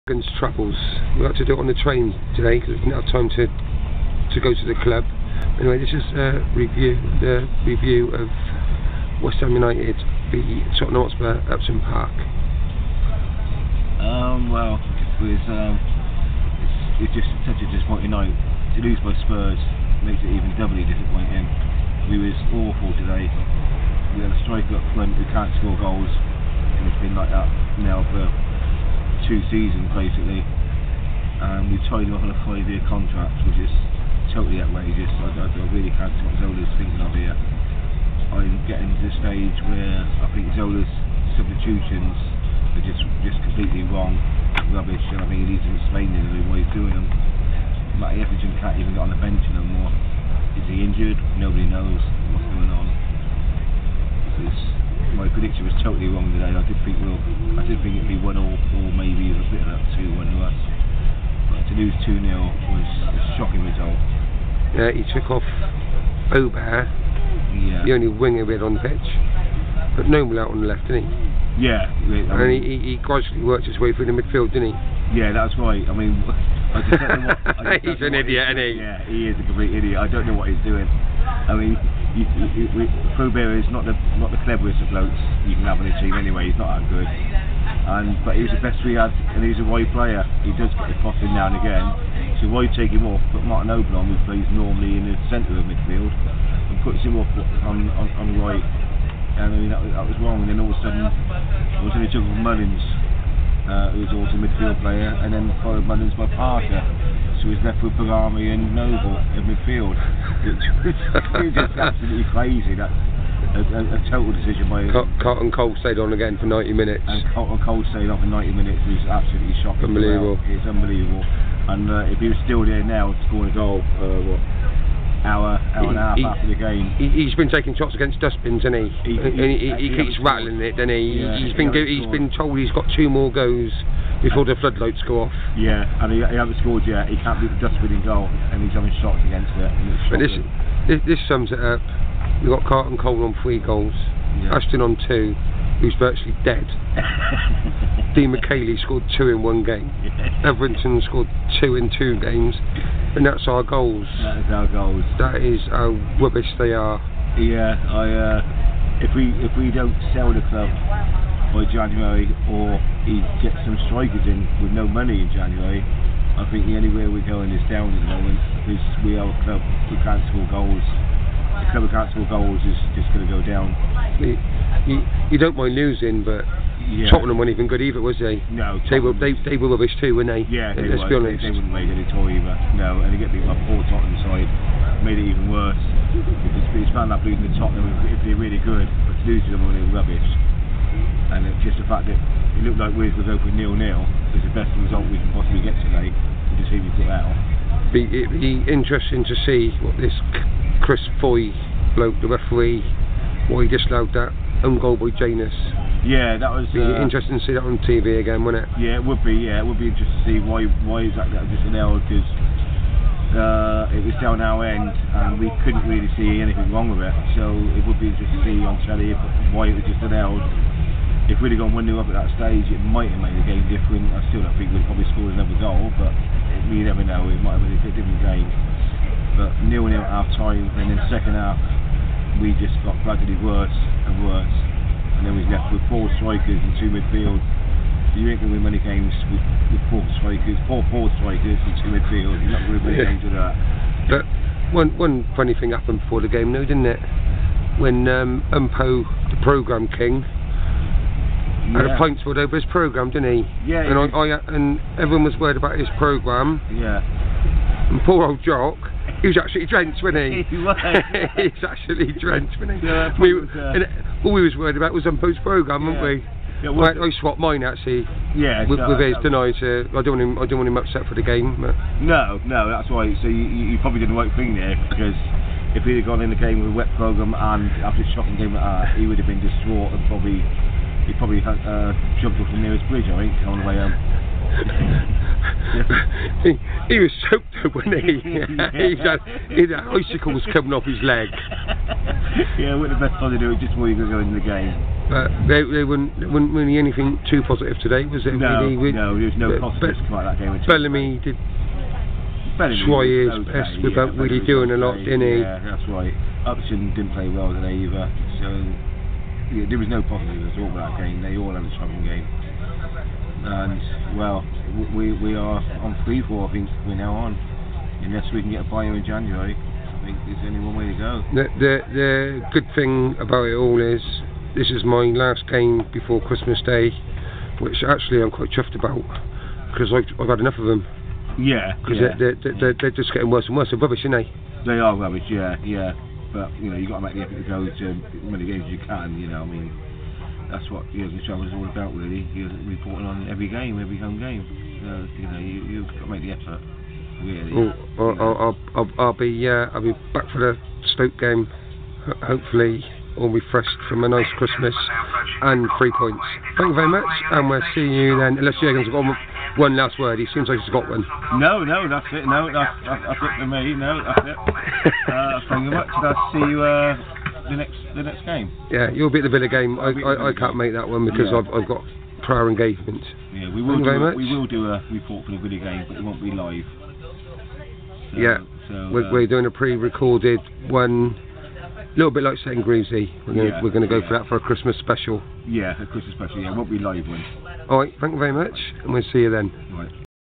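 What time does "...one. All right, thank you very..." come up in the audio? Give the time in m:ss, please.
6:27.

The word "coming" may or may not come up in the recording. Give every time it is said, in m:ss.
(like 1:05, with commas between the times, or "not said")
4:50.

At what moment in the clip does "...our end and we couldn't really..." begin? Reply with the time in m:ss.
3:34.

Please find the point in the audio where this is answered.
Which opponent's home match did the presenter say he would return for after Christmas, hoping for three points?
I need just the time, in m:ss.
5:50.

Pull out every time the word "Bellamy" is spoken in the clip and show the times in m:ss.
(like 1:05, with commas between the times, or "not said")
1:47, 5:00.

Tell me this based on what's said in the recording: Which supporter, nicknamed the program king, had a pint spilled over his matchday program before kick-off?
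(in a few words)
Umpo.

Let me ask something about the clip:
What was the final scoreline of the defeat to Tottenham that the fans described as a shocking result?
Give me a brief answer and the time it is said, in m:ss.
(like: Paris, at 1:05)
2-0, at 1:02.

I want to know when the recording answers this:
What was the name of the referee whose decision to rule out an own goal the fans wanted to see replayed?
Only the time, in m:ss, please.
3:20.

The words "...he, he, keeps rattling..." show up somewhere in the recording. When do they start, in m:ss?
2:09.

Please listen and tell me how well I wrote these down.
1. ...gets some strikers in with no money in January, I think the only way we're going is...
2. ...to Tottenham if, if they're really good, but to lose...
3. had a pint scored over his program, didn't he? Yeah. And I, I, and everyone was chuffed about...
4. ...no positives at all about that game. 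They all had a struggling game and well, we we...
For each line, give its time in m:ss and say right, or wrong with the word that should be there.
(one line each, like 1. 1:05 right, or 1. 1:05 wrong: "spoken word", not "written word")
1. 2:43 right
2. 3:07 right
3. 4:11 wrong: "worried", not "chuffed"
4. 5:09 right.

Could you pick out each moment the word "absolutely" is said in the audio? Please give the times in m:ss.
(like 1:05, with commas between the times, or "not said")
1:51, 1:59.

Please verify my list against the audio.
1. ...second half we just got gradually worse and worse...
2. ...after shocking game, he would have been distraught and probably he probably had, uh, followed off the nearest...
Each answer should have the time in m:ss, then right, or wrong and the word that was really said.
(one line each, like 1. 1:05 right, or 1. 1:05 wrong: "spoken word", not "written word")
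1. 3:51 right
2. 4:37 wrong: "jumped", not "followed".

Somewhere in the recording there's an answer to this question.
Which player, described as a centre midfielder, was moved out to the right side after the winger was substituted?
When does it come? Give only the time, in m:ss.
1:33.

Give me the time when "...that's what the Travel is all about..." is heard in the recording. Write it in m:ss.
5:40.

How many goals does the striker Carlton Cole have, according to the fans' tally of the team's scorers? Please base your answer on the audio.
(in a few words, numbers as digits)
3.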